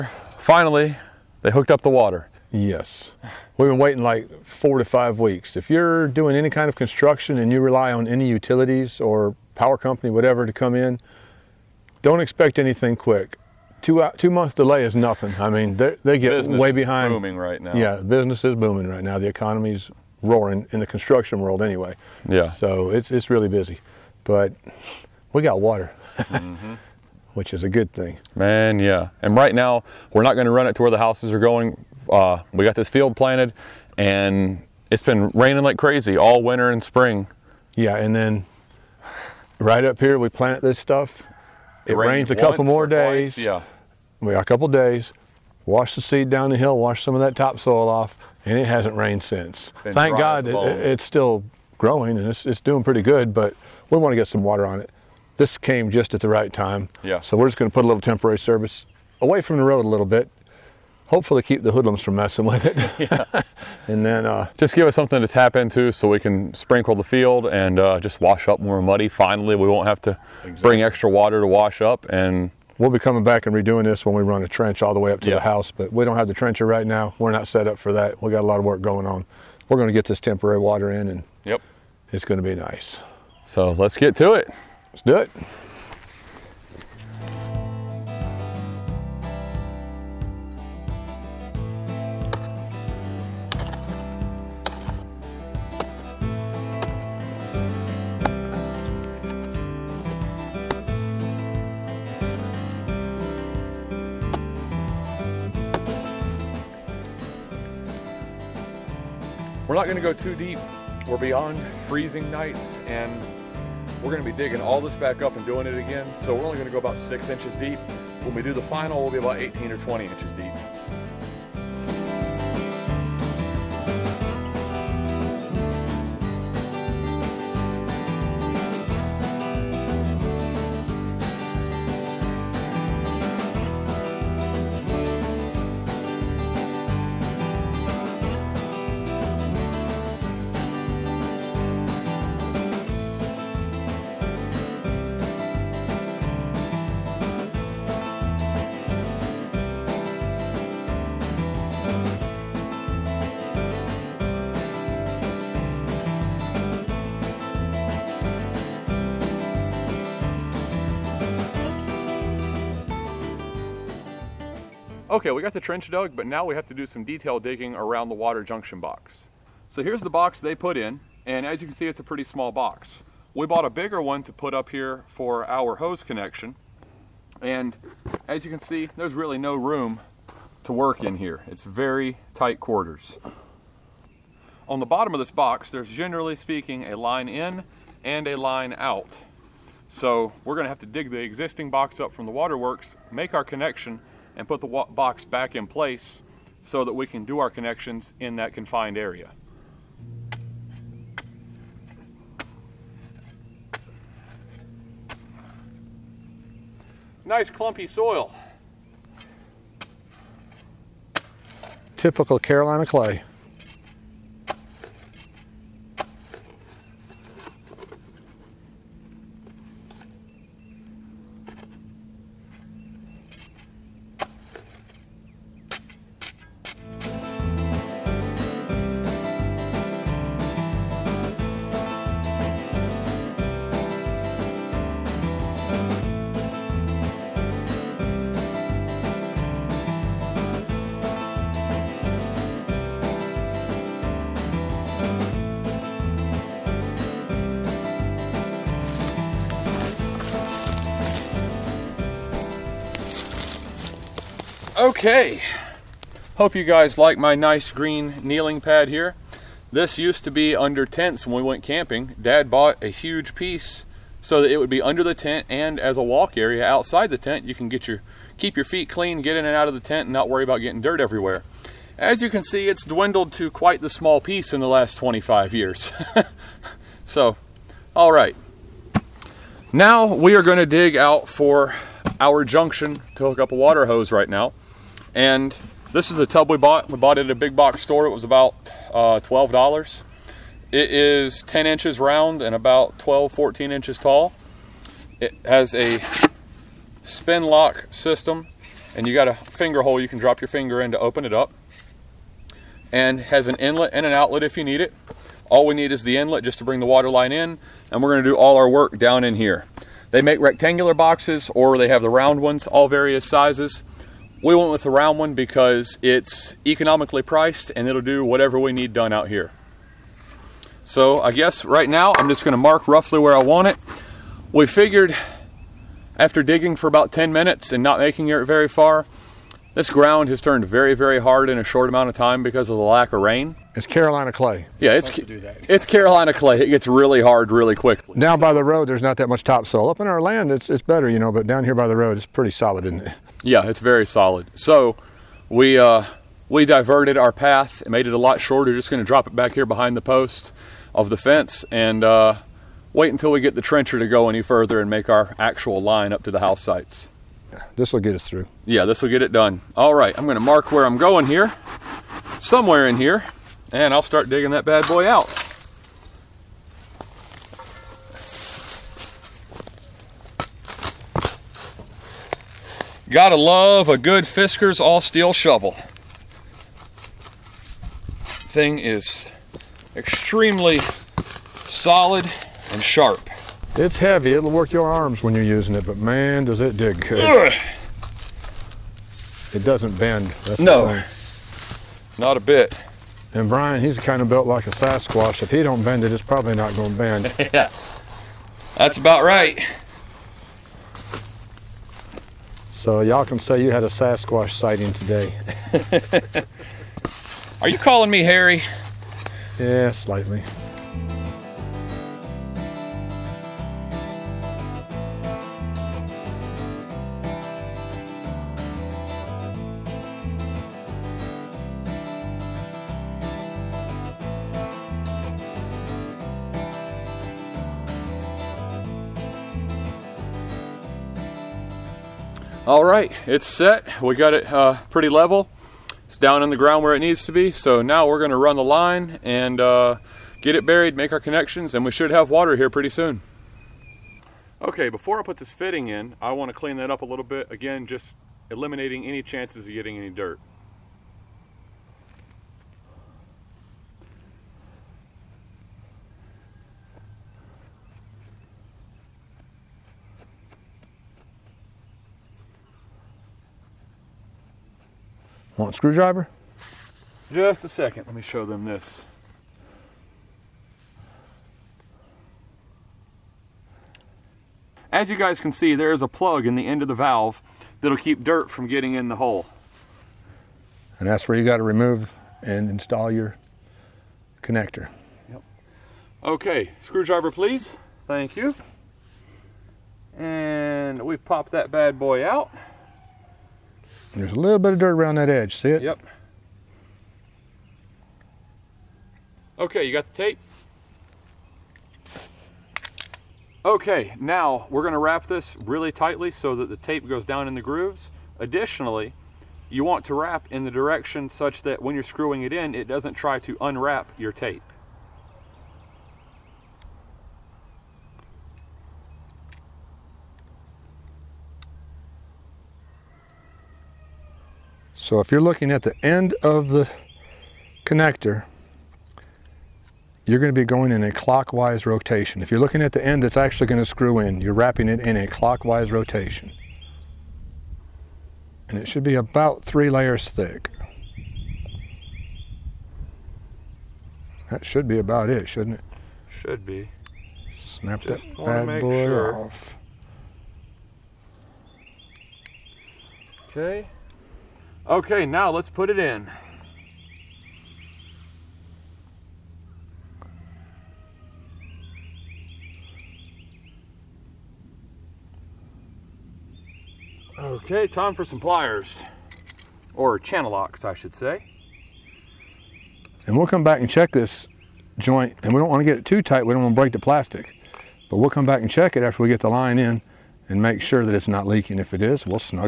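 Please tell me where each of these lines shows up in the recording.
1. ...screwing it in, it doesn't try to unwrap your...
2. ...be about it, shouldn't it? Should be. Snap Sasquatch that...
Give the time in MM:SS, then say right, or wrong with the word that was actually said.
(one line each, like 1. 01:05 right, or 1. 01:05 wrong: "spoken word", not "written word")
1. 08:32 right
2. 09:04 wrong: "Just", not "Sasquatch".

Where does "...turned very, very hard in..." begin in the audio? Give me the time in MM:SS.
05:30.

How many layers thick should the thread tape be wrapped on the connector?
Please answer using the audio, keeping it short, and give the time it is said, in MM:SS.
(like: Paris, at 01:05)
3 layers, at 08:59.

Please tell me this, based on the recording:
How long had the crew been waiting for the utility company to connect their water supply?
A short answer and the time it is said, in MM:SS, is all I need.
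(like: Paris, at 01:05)
4 to 5 weeks, at 00:04.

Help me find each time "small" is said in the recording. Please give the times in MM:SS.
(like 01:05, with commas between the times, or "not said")
02:52, 04:33.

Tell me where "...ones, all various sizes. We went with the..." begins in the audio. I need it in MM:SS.
05:12.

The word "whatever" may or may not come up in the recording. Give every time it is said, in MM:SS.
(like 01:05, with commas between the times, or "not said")
00:10, 05:18.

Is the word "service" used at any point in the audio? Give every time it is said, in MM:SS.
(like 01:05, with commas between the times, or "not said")
00:58.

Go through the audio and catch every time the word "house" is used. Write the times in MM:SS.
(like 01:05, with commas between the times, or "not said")
00:31, 01:15, 05:56.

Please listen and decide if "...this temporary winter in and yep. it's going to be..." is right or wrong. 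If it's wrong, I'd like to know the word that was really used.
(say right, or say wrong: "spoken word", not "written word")
wrong: "water", not "winter".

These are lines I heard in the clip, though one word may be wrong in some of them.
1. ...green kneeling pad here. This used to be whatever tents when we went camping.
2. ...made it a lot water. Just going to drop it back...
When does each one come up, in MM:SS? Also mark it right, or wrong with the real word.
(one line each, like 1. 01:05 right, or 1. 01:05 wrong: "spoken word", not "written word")
1. 04:17 wrong: "under", not "whatever"
2. 05:47 wrong: "shorter", not "water".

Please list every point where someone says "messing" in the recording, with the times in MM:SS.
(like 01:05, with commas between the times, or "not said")
01:02.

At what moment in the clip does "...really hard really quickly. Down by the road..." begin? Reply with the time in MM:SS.
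05:36.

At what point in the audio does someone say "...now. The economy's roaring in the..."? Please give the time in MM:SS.
00:19.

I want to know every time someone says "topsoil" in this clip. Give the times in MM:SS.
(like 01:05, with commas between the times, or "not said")
00:47, 05:39.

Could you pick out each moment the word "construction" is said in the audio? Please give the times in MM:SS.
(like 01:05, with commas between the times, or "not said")
00:06, 00:20.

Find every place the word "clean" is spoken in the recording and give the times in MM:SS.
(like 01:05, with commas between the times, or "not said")
04:28, 07:26.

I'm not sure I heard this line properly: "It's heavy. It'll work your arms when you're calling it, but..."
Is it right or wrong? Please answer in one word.
wrong.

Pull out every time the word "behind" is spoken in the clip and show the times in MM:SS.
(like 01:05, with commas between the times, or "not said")
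00:16, 05:49.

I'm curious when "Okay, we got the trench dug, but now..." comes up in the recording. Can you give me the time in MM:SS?
02:45.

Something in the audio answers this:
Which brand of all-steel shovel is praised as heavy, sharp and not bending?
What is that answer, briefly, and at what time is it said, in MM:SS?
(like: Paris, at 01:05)
Fiskars, at 06:14.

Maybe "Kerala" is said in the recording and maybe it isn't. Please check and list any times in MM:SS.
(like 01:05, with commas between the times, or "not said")
not said.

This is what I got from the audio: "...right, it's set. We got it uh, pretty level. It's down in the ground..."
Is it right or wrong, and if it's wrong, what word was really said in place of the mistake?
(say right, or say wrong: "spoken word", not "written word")
right.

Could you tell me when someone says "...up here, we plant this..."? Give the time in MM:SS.
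00:39.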